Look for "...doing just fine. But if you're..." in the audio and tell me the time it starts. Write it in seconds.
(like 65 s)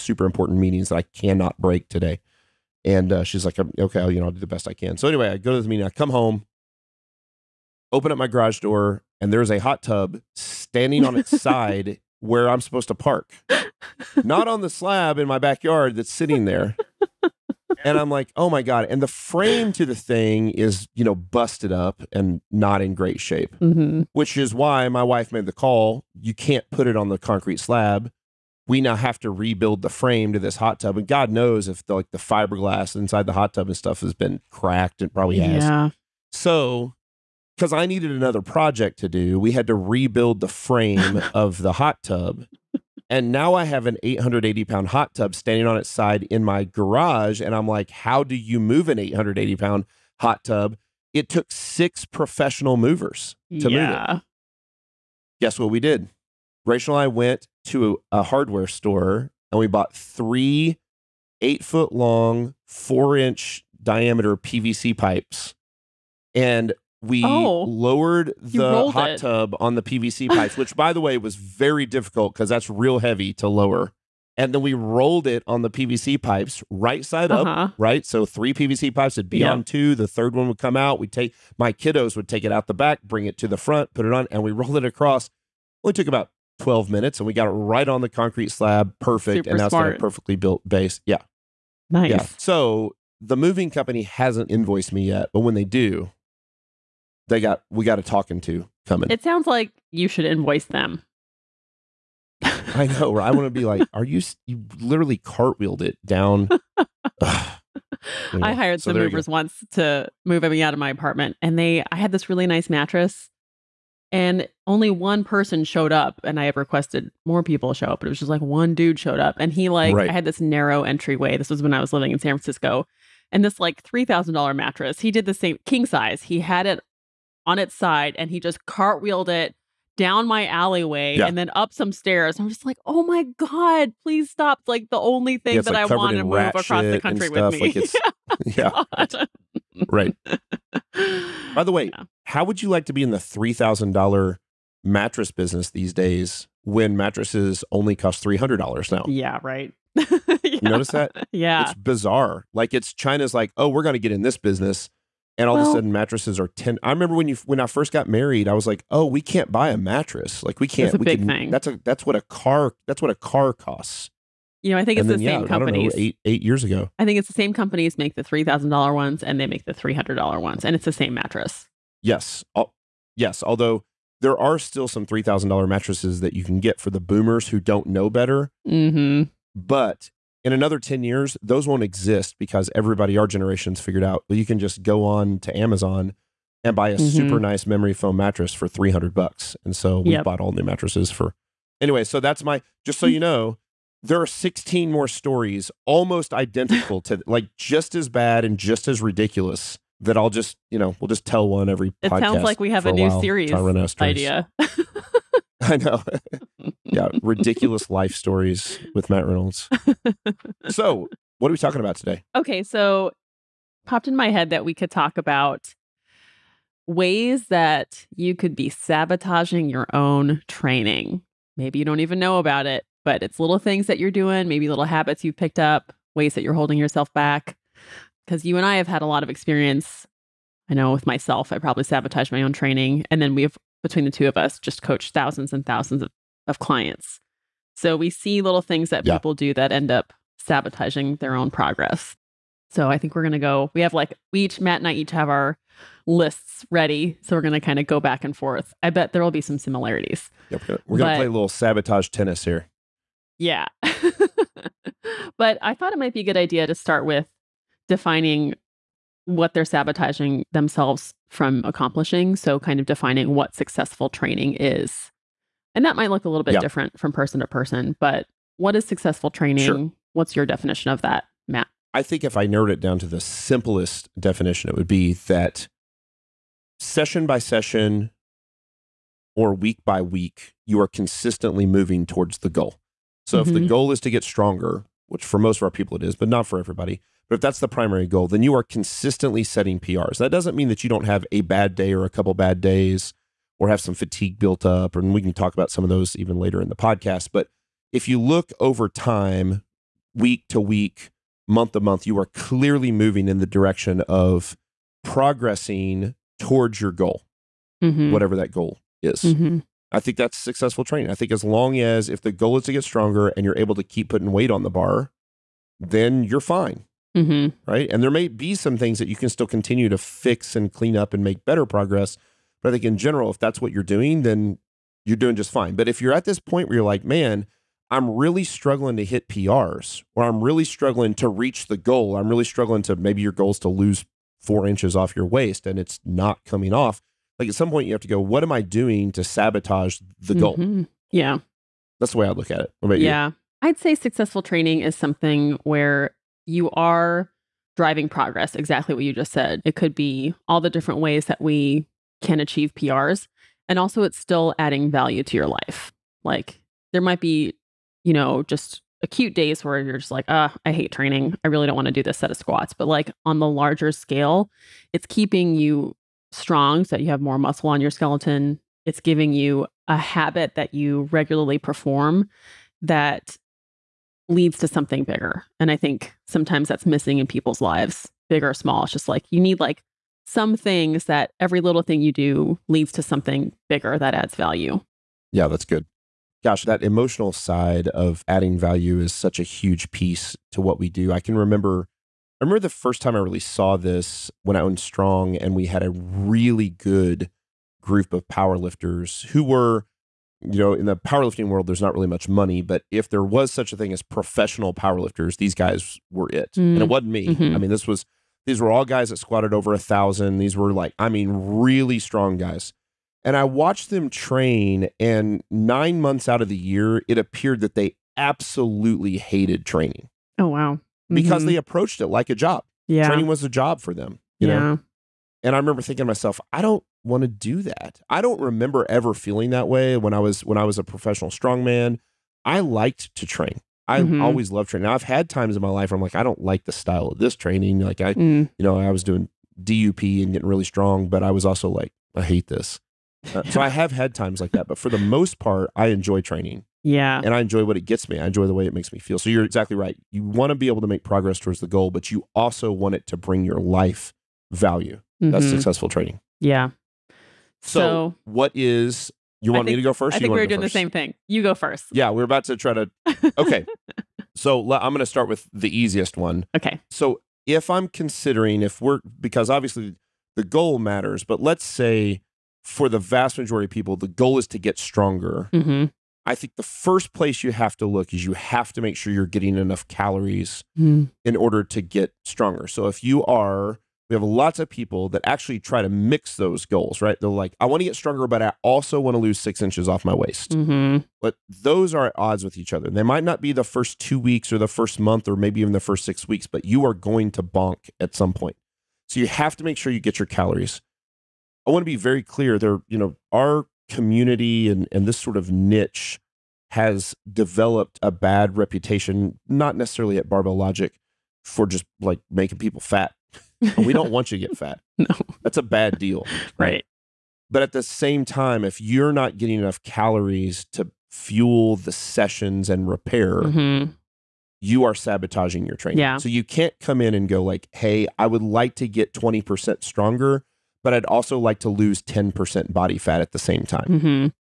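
325 s.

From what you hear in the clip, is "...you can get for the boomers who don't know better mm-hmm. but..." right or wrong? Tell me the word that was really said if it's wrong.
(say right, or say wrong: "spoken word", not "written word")
right.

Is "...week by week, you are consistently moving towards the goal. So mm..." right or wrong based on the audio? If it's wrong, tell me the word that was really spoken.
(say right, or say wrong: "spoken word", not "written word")
right.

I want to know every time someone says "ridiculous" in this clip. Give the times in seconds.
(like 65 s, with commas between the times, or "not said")
199 s, 207 s.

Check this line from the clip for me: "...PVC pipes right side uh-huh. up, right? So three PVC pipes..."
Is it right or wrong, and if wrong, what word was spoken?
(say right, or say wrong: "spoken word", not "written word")
right.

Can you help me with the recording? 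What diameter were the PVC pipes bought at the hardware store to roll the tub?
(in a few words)
4 inch.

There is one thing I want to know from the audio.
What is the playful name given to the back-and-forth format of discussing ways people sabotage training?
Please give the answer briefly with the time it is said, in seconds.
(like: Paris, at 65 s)
sabotage tennis, at 251 s.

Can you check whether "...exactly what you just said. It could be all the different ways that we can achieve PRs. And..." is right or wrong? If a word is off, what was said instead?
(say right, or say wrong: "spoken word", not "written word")
right.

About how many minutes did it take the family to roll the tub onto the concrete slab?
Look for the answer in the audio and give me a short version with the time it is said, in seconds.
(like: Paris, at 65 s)
12, at 86 s.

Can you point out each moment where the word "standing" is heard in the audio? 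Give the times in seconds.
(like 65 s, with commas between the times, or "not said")
10 s, 45 s.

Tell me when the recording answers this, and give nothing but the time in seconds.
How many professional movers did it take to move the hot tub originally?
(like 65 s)
51 s.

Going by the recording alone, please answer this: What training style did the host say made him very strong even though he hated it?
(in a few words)
DUP.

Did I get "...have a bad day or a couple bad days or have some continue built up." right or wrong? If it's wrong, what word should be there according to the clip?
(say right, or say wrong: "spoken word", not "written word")
wrong: "fatigue", not "continue".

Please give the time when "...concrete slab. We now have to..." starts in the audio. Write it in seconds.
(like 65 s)
27 s.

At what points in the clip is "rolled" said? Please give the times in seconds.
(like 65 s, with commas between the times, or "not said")
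74 s, 84 s.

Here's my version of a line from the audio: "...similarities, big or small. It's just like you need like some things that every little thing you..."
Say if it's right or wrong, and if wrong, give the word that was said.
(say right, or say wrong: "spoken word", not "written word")
wrong: "lives", not "similarities".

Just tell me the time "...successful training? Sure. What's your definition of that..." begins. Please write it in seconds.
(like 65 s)
268 s.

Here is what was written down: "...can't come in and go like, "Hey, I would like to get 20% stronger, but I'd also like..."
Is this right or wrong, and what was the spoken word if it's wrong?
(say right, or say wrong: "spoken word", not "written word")
right.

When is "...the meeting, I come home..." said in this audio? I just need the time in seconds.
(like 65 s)
5 s.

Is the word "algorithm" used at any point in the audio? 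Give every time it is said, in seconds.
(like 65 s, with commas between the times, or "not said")
not said.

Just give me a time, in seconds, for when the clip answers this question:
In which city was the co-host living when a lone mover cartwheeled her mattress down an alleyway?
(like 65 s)
122 s.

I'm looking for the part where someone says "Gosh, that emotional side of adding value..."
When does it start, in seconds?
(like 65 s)
386 s.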